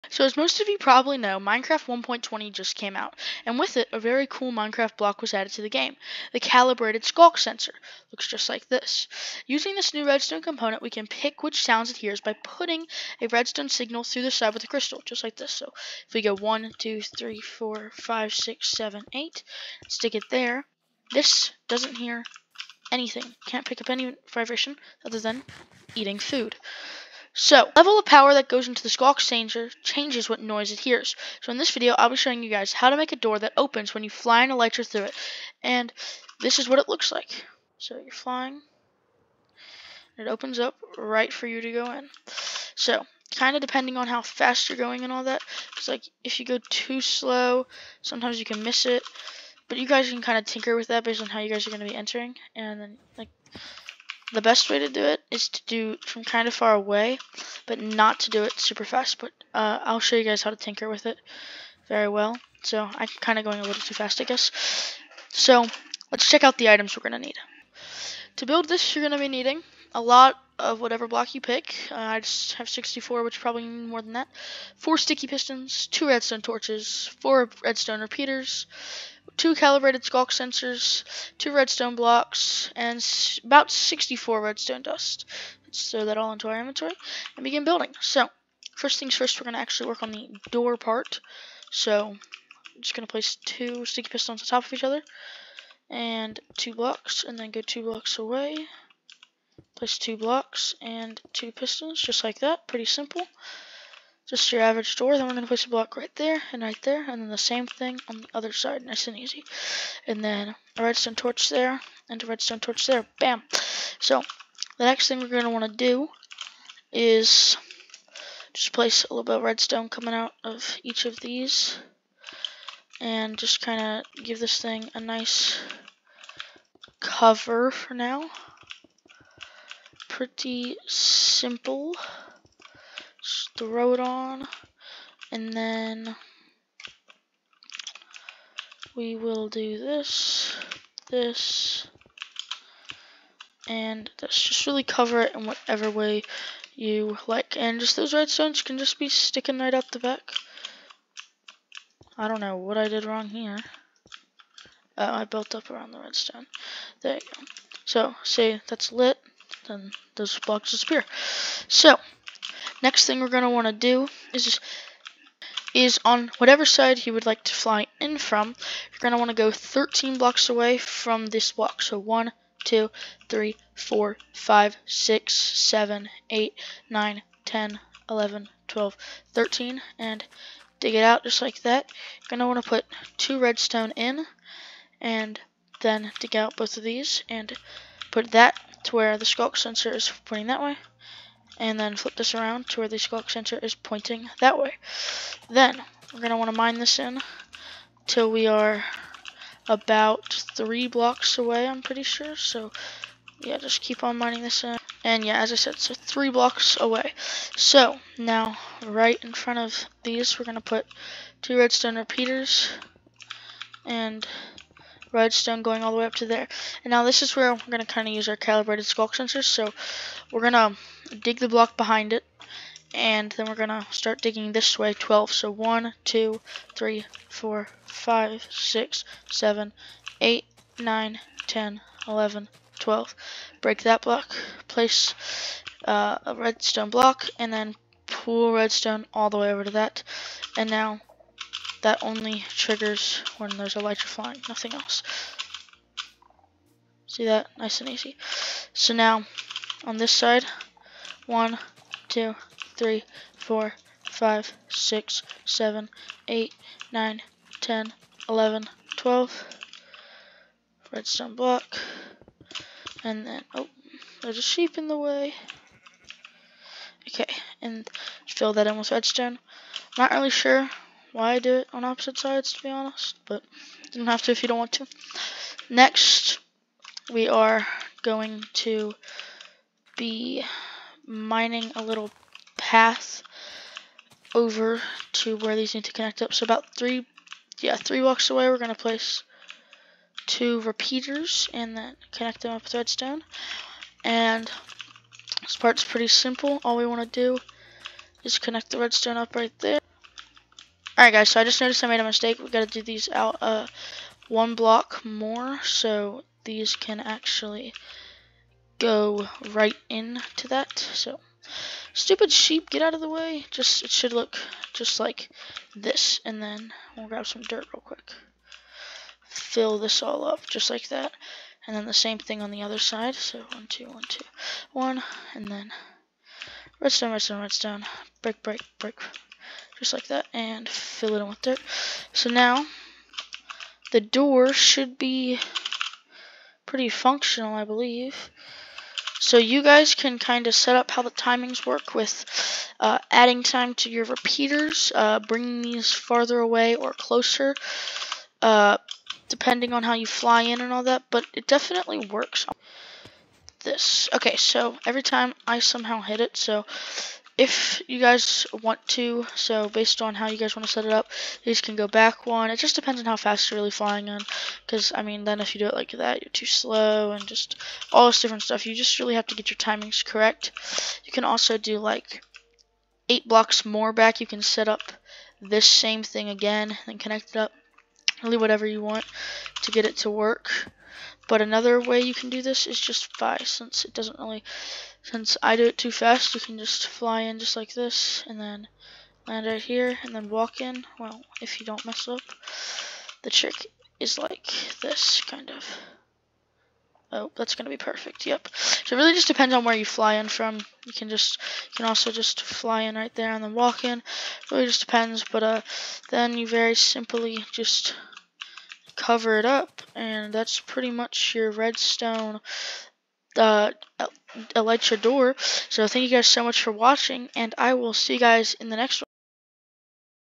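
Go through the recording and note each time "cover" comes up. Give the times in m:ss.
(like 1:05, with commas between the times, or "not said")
2:06, 2:24, 6:49.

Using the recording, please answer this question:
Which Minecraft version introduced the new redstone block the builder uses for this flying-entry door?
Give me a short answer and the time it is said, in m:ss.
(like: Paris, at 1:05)
1.20, at 0:01.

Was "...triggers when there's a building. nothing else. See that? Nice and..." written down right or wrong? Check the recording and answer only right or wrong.
wrong.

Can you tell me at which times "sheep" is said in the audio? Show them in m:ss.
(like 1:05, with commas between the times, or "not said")
4:24, 5:12.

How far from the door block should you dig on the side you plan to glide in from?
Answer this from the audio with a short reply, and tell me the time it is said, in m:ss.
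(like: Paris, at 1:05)
13 blocks, at 2:49.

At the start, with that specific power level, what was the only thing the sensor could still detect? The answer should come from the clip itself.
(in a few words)
Eating food.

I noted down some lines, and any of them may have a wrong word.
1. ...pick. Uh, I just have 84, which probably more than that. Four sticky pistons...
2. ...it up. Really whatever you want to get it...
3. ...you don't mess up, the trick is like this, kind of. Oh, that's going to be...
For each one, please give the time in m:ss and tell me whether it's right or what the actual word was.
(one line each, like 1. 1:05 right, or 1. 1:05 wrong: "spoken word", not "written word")
1. 1:11 wrong: "64", not "84"
2. 6:17 right
3. 6:31 right.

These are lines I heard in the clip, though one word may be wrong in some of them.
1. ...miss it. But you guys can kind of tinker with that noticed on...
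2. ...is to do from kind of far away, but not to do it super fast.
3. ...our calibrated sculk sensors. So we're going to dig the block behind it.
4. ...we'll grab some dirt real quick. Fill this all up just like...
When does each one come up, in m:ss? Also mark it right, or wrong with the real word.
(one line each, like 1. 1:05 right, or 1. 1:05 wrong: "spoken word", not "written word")
1. 0:48 wrong: "based", not "noticed"
2. 0:55 right
3. 3:38 right
4. 5:16 right.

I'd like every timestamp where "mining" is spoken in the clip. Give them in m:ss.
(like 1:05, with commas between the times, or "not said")
3:24, 4:41.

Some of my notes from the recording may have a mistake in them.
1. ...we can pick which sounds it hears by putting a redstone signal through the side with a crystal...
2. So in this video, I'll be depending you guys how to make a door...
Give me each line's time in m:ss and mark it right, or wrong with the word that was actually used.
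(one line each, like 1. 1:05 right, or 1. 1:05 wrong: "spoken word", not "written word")
1. 0:10 right
2. 0:31 wrong: "showing", not "depending".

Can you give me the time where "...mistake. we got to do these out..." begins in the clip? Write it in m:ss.
5:02.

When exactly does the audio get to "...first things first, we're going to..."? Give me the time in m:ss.
1:28.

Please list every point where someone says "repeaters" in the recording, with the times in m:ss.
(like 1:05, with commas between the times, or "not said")
1:18, 3:31, 4:50, 5:44.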